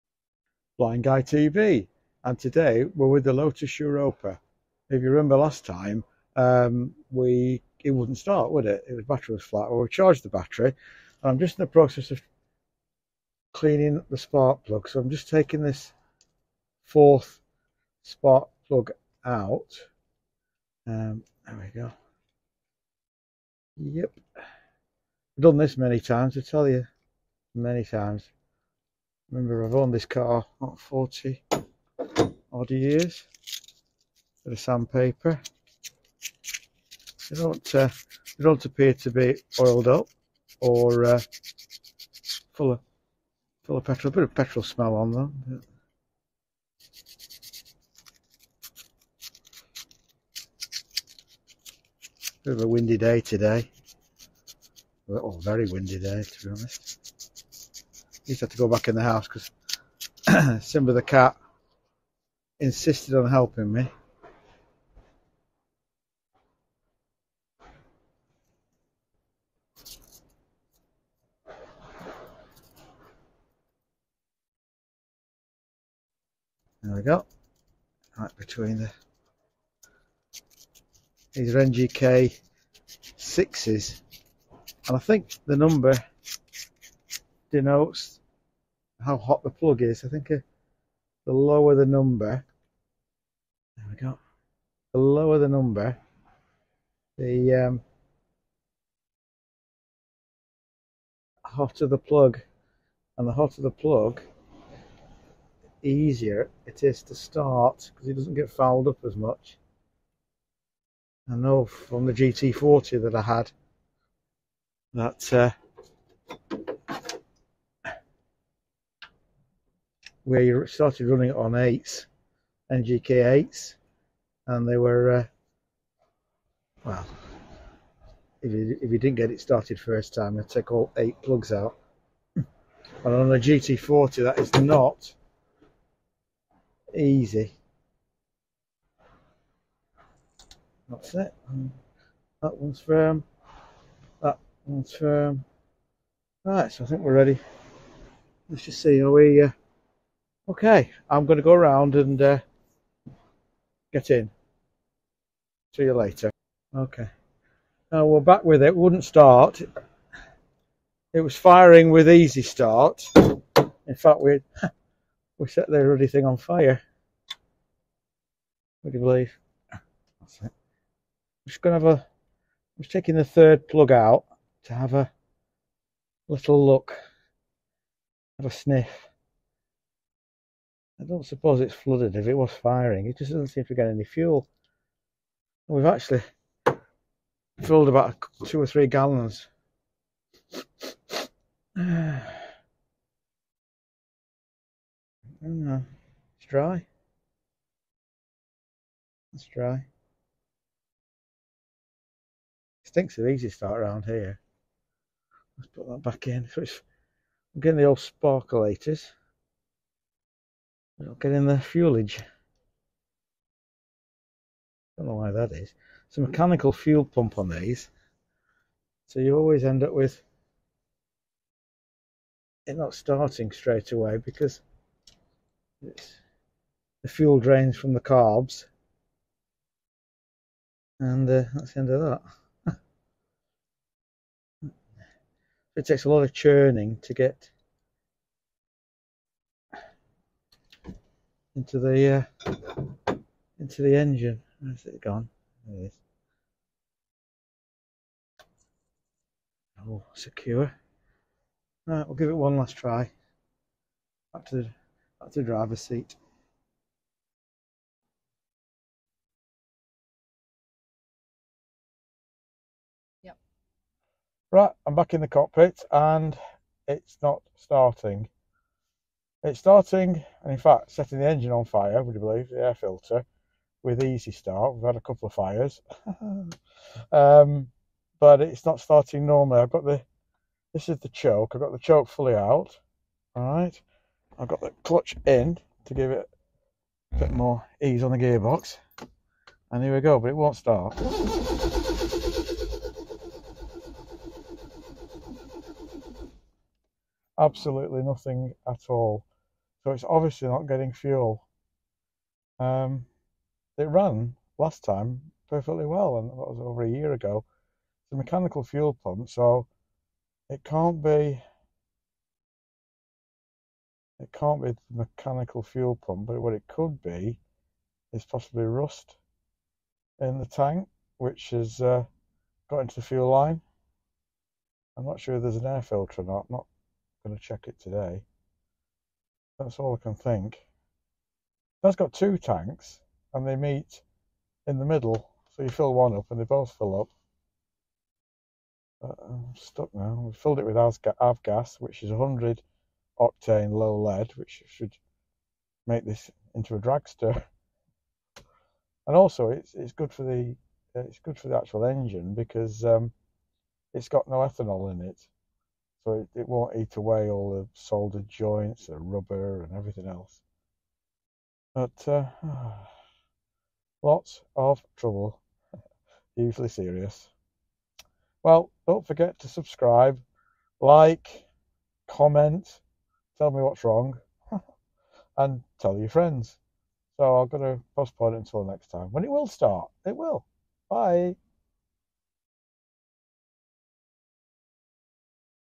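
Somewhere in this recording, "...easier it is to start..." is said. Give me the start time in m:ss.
1:45.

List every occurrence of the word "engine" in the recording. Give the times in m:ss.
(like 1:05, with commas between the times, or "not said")
4:03, 4:31, 5:51.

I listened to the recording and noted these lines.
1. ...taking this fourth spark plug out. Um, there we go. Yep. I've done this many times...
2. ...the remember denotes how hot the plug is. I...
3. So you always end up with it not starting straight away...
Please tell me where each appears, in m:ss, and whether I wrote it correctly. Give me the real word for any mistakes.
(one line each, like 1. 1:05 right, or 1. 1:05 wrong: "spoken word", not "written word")
1. 0:15 right
2. 1:25 wrong: "number", not "remember"
3. 3:39 right.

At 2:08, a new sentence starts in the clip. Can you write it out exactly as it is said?
If you, if you didn't get it started first time, you take all eight plugs out.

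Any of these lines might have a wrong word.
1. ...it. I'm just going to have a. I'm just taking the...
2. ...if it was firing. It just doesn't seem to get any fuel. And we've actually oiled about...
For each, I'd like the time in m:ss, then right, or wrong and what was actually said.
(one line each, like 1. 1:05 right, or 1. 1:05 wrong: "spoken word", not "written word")
1. 2:50 right
2. 3:02 wrong: "filled", not "oiled".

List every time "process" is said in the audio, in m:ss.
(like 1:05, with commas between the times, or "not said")
0:11.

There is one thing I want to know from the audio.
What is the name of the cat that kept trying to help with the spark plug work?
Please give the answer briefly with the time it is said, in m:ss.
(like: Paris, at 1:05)
Simba, at 1:00.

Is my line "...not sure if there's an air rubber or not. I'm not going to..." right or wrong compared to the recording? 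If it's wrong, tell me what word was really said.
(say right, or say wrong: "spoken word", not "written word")
wrong: "filter", not "rubber".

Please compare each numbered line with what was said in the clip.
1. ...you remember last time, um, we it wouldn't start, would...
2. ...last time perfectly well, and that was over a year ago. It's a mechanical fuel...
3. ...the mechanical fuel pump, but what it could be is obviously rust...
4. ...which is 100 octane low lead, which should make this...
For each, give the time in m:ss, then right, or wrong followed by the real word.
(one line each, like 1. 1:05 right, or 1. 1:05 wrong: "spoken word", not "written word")
1. 0:05 right
2. 5:04 right
3. 5:14 wrong: "possibly", not "obviously"
4. 5:41 right.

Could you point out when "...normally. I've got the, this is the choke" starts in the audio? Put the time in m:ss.
4:39.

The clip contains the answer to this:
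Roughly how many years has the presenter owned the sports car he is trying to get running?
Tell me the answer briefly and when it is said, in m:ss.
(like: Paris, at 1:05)
40, at 0:30.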